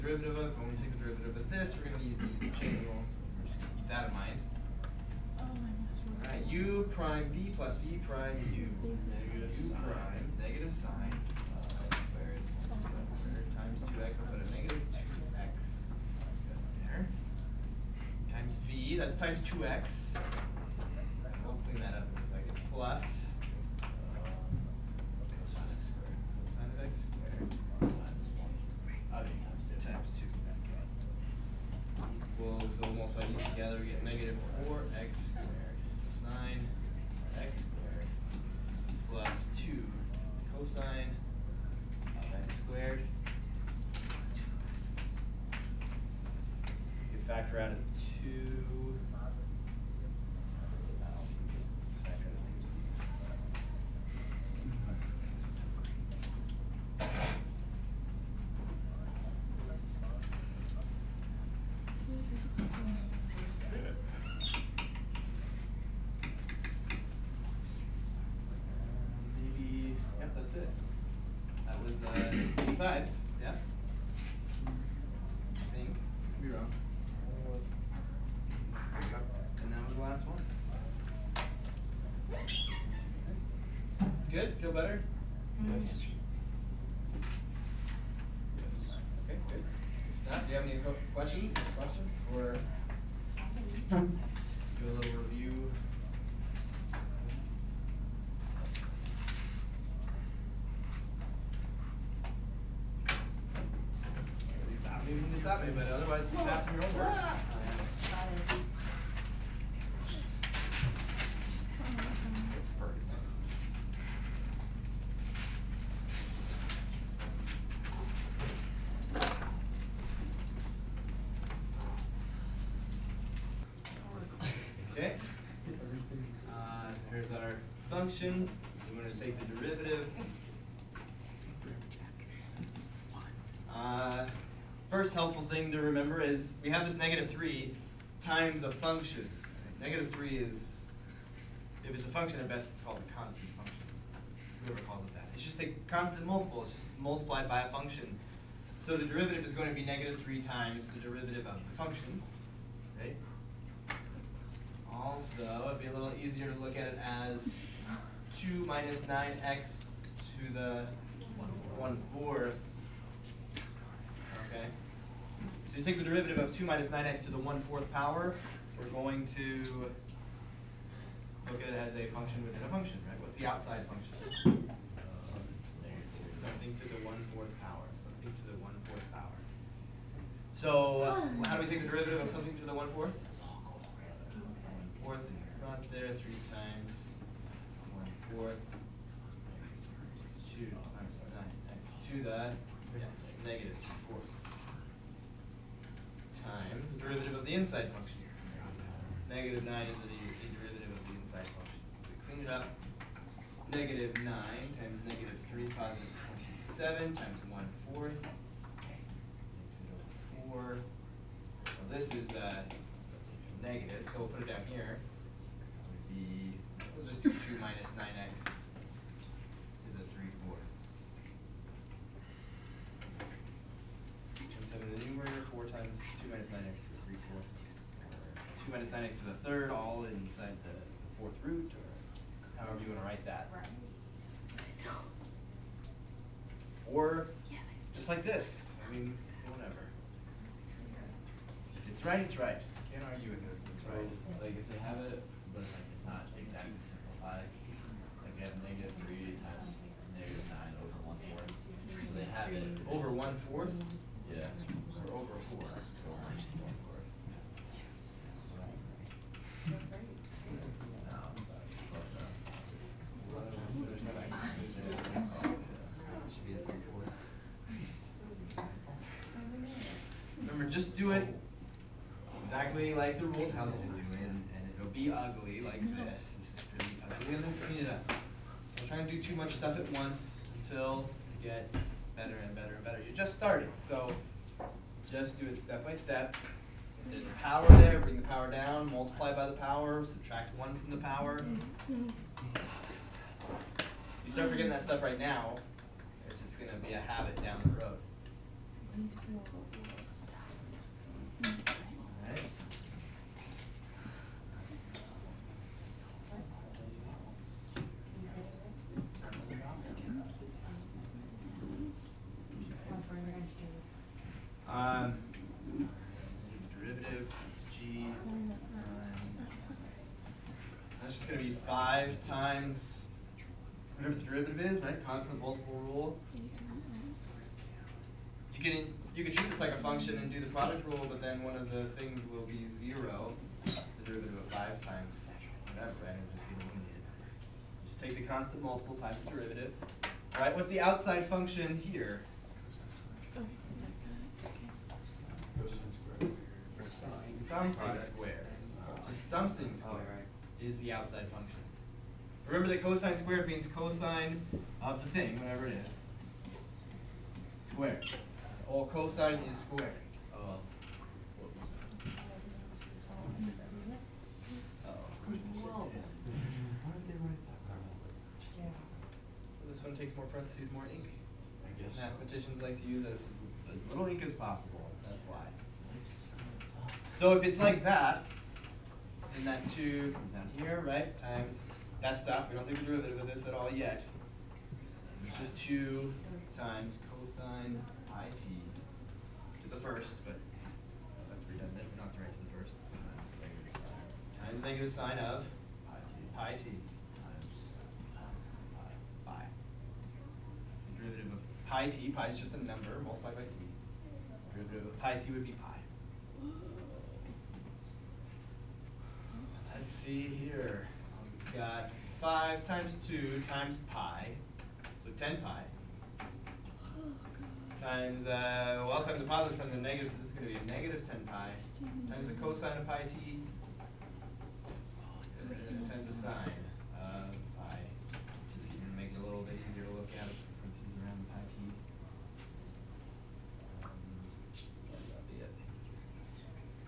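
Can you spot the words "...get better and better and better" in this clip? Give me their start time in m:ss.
4:41.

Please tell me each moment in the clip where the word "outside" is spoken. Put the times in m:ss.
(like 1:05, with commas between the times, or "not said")
2:53, 5:40, 5:50.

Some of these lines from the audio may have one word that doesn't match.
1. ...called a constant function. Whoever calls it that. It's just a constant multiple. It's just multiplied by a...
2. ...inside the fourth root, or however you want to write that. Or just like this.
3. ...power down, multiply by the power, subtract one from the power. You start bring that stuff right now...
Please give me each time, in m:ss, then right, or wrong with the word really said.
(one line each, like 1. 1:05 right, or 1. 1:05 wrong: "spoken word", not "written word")
1. 2:22 right
2. 3:50 right
3. 4:48 wrong: "forgetting", not "bring".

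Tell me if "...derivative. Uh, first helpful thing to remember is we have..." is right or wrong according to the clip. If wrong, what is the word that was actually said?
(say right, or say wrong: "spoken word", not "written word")
right.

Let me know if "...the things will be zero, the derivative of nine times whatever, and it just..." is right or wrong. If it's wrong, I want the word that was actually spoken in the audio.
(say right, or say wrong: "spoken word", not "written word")
wrong: "five", not "nine".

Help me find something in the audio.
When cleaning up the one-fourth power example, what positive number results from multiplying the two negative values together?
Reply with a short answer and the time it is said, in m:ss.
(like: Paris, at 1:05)
27, at 3:25.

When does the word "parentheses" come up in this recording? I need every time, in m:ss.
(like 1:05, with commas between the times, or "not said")
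6:10.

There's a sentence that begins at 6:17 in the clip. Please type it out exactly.
So if it's like that, then that 2 comes down here, right, times that stuff.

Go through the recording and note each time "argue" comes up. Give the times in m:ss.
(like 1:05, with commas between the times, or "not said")
4:03.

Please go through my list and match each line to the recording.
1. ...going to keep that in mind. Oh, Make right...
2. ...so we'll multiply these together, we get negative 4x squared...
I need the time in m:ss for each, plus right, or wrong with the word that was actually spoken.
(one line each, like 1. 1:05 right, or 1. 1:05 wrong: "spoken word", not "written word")
1. 0:03 wrong: "All", not "Make"
2. 0:32 right.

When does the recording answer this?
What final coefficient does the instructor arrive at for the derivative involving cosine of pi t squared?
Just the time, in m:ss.
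7:00.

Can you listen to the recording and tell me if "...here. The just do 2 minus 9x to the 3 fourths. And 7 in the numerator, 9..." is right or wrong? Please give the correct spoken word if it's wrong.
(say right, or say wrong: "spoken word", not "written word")
wrong: "4", not "9".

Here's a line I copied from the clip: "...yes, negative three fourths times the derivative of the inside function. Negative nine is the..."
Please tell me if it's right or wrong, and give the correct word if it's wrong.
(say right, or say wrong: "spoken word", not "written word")
right.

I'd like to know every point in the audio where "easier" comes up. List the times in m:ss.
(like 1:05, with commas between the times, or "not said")
2:36, 7:09.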